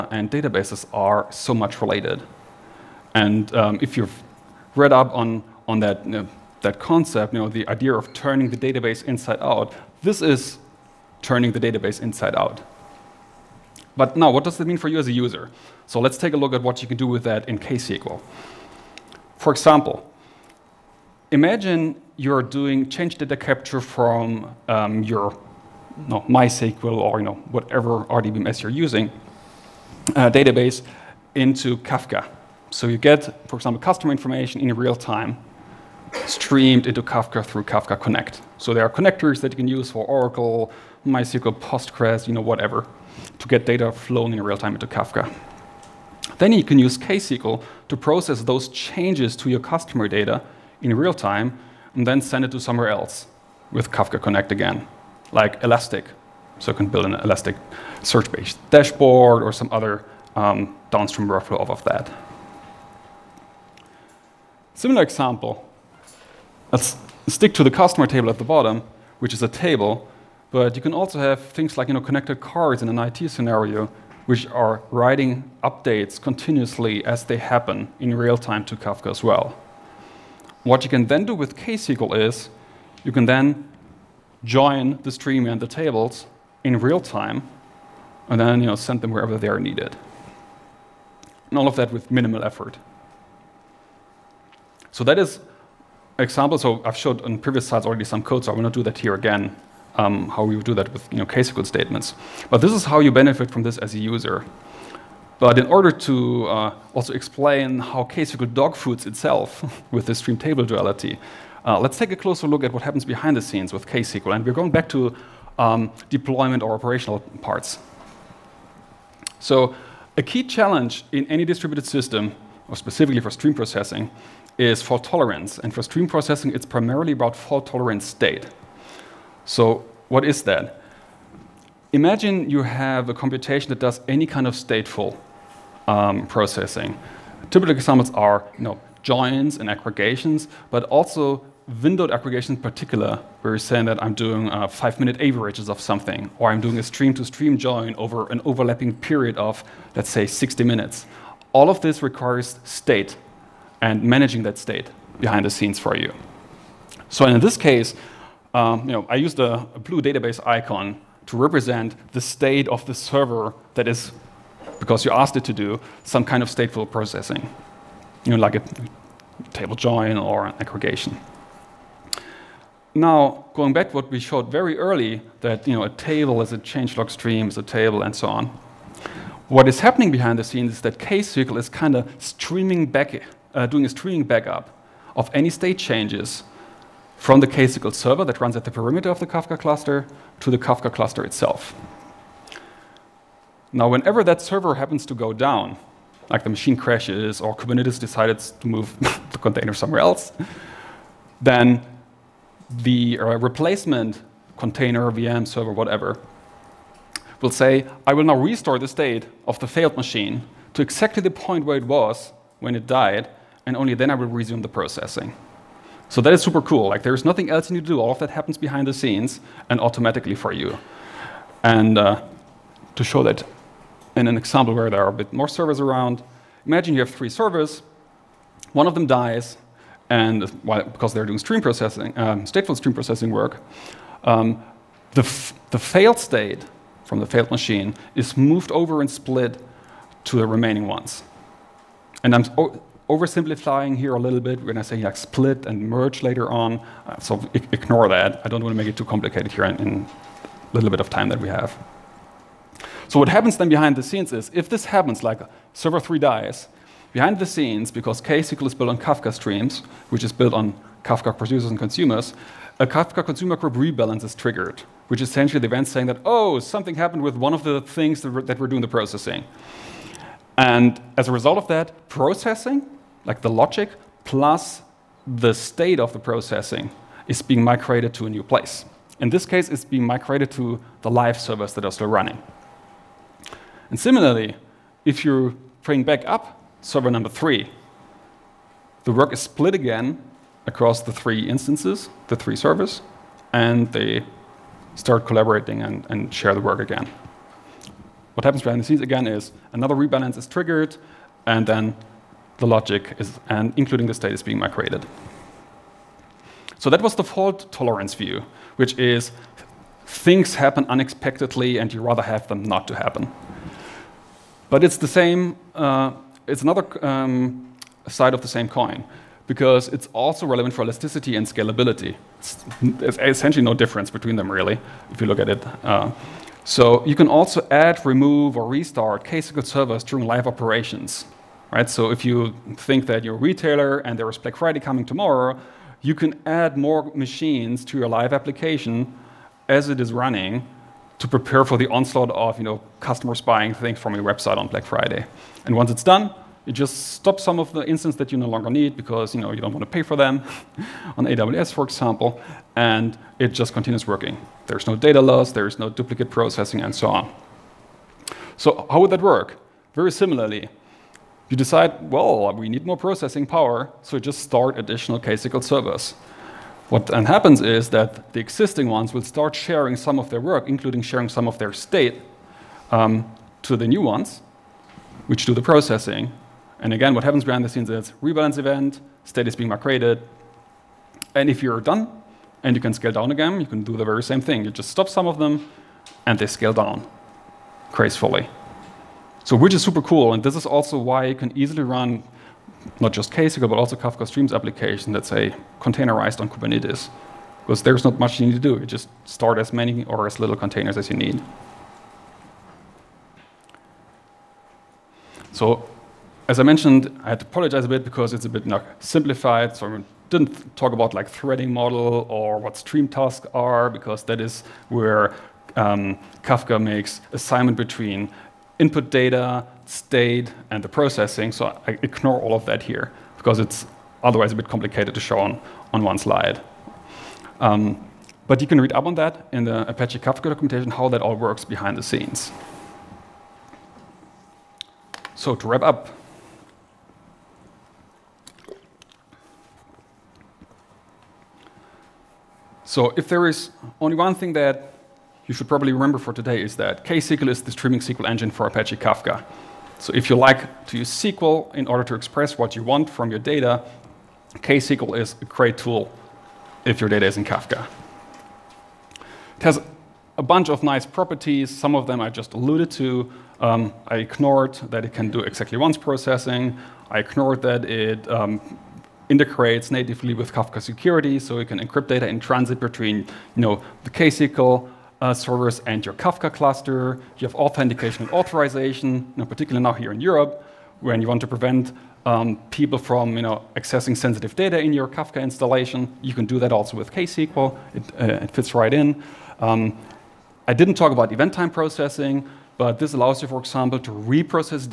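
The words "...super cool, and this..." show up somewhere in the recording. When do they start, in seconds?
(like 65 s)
389 s.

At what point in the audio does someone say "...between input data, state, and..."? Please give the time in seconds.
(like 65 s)
417 s.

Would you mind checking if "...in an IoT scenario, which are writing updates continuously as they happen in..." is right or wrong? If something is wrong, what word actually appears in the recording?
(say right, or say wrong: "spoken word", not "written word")
right.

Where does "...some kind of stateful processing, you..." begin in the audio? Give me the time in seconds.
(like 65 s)
166 s.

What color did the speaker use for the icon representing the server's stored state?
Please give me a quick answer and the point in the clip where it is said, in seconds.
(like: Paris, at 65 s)
blue, at 159 s.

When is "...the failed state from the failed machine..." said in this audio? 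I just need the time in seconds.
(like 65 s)
235 s.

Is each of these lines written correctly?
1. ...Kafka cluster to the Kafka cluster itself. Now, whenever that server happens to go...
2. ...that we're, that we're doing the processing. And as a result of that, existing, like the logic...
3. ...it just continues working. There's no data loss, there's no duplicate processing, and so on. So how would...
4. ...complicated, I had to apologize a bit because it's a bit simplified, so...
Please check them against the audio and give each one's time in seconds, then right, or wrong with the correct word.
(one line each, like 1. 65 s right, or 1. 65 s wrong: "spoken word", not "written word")
1. 189 s right
2. 268 s wrong: "processing", not "existing"
3. 353 s right
4. 406 s wrong: "mentioned", not "complicated".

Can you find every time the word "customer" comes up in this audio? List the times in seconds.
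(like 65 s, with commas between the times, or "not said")
33 s, 49 s, 67 s, 342 s.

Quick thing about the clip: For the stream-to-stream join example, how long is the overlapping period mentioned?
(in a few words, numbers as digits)
60 minutes.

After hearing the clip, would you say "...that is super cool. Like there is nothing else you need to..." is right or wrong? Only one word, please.
right.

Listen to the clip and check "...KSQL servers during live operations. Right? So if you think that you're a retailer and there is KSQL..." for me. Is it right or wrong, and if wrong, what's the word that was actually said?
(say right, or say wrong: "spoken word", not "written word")
wrong: "Black", not "KSQL".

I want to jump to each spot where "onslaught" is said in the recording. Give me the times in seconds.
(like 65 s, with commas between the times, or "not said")
341 s.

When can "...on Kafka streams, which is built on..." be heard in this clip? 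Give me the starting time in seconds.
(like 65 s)
258 s.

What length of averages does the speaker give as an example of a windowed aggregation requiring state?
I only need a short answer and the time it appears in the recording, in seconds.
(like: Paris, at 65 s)
five-minute, at 144 s.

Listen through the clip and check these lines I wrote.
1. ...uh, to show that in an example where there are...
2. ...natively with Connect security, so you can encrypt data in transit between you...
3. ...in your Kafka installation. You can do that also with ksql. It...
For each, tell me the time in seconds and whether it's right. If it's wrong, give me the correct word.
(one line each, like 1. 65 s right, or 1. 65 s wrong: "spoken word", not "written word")
1. 221 s right
2. 469 s wrong: "Kafka", not "Connect"
3. 484 s right.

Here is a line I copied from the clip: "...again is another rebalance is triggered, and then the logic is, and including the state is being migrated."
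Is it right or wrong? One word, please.
right.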